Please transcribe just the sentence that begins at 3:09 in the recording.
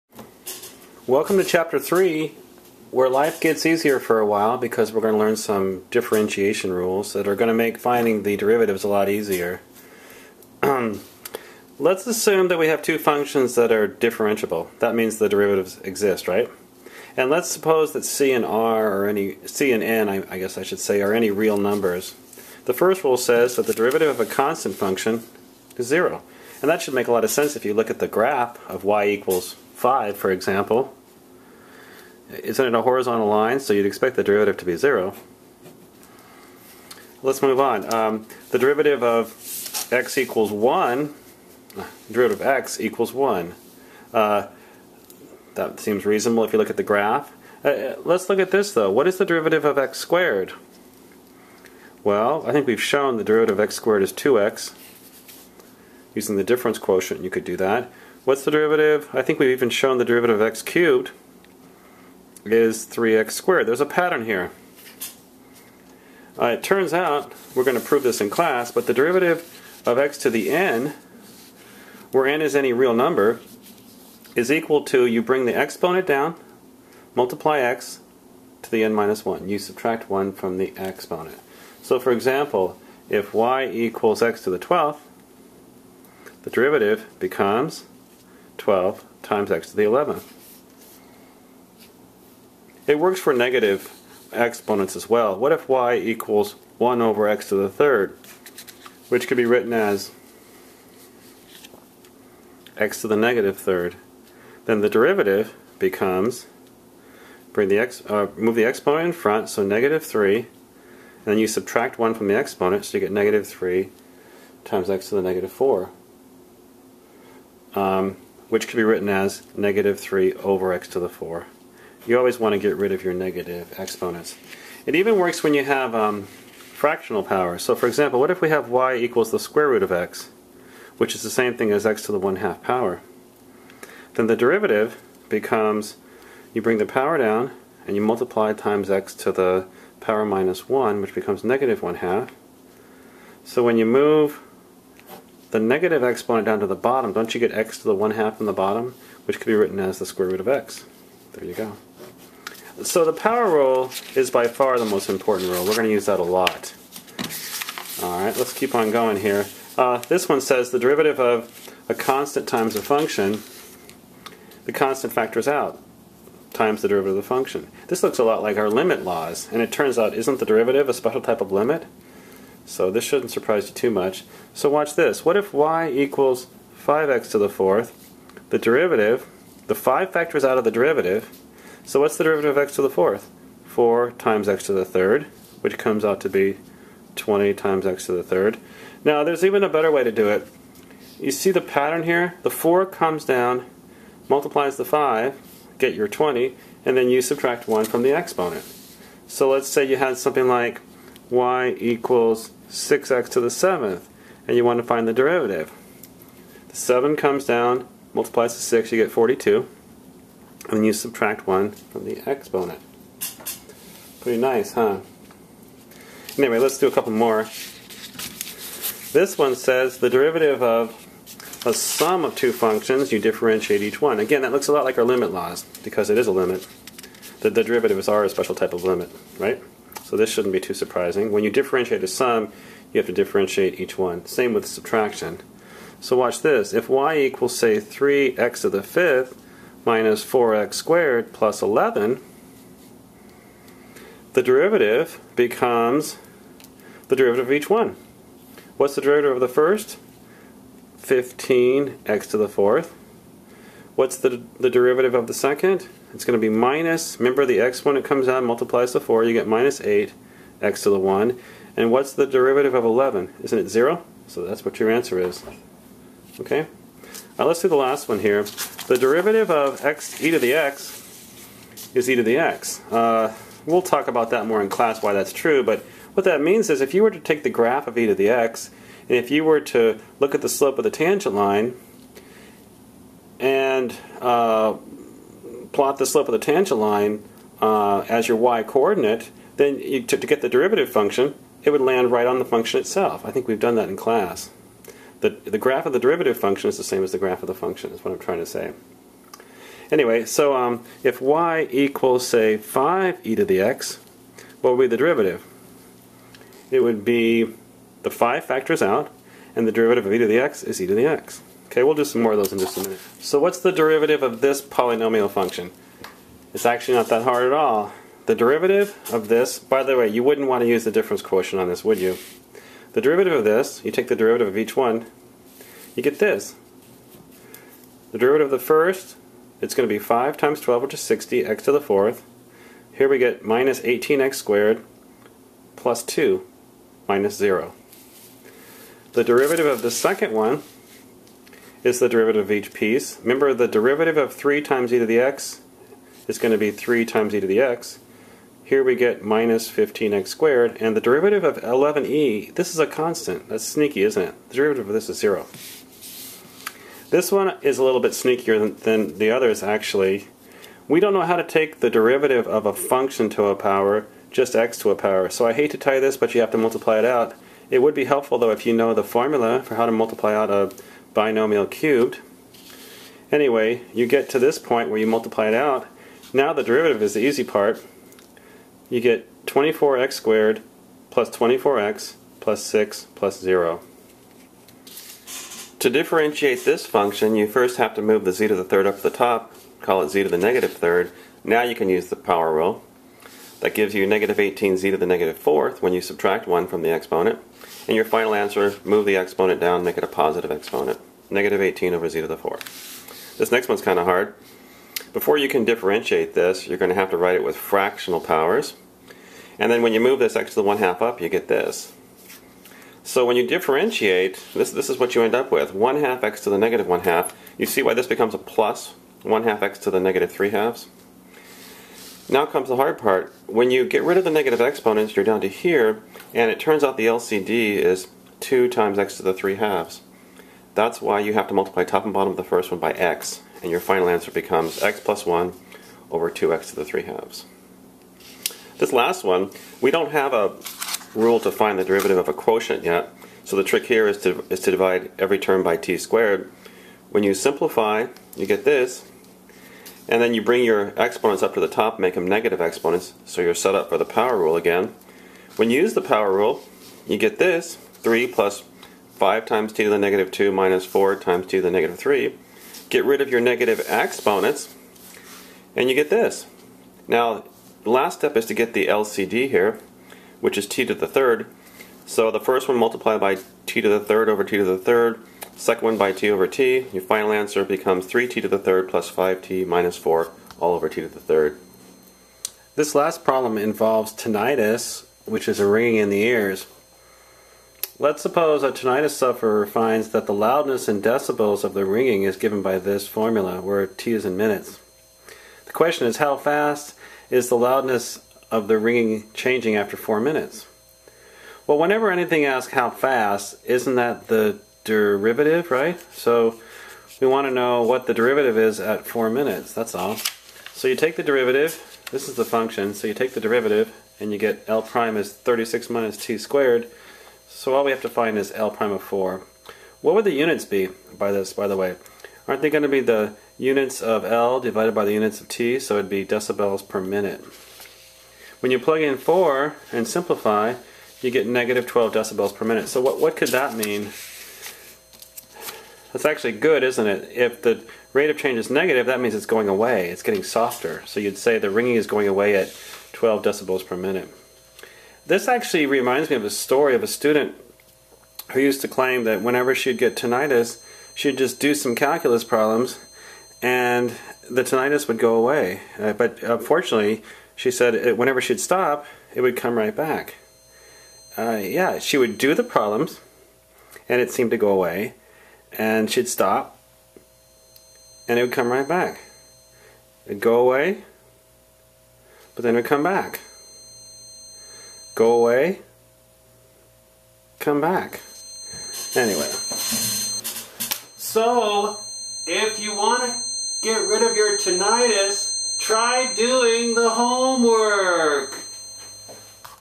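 Now there's even a better way to do it.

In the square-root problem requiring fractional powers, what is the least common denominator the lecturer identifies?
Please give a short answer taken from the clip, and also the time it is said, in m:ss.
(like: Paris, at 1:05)
2x^(3/2), at 7:08.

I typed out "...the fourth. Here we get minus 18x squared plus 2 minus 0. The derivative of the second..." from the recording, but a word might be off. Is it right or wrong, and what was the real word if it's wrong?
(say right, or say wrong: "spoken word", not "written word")
right.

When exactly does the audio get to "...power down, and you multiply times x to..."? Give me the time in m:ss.
2:16.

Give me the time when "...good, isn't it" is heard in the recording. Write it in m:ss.
8:56.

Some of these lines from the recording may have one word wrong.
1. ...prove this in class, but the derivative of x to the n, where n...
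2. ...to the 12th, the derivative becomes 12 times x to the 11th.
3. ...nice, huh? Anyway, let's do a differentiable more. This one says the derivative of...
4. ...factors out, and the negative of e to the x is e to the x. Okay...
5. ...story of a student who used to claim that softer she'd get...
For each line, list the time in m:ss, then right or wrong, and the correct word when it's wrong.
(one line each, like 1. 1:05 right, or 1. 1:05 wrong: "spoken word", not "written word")
1. 1:07 right
2. 1:24 right
3. 3:34 wrong: "couple", not "differentiable"
4. 5:08 wrong: "derivative", not "negative"
5. 9:06 wrong: "whenever", not "softer".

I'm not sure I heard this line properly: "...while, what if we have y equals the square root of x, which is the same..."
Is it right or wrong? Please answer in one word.
wrong.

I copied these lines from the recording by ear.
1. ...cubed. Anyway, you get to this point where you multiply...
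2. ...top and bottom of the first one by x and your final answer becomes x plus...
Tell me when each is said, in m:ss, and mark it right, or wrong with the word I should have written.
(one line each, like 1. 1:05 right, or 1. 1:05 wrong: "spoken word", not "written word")
1. 6:11 right
2. 7:11 right.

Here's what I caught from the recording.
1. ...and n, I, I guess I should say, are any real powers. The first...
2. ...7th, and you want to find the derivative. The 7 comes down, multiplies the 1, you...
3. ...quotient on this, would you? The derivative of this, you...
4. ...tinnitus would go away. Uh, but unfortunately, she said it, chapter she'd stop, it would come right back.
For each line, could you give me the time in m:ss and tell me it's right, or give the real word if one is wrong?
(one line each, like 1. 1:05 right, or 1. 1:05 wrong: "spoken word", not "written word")
1. 0:19 wrong: "numbers", not "powers"
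2. 3:23 wrong: "6", not "1"
3. 5:21 right
4. 9:14 wrong: "whenever", not "chapter".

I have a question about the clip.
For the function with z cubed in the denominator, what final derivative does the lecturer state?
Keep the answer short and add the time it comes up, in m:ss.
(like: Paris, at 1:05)
-18/z^4, at 6:41.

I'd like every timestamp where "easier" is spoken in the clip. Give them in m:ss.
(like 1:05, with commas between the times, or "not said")
0:03, 0:09.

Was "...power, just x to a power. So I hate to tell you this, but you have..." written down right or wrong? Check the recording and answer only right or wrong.
right.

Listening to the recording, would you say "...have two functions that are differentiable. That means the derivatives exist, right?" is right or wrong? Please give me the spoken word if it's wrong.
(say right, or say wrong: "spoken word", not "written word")
right.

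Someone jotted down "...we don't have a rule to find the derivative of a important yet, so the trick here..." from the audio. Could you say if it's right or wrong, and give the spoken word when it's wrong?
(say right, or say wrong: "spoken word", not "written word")
wrong: "quotient", not "important".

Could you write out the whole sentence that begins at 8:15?
The question is how fast is the loudness of the ringing changing after four minutes?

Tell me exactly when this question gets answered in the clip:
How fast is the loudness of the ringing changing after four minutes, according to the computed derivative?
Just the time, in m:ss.
8:51.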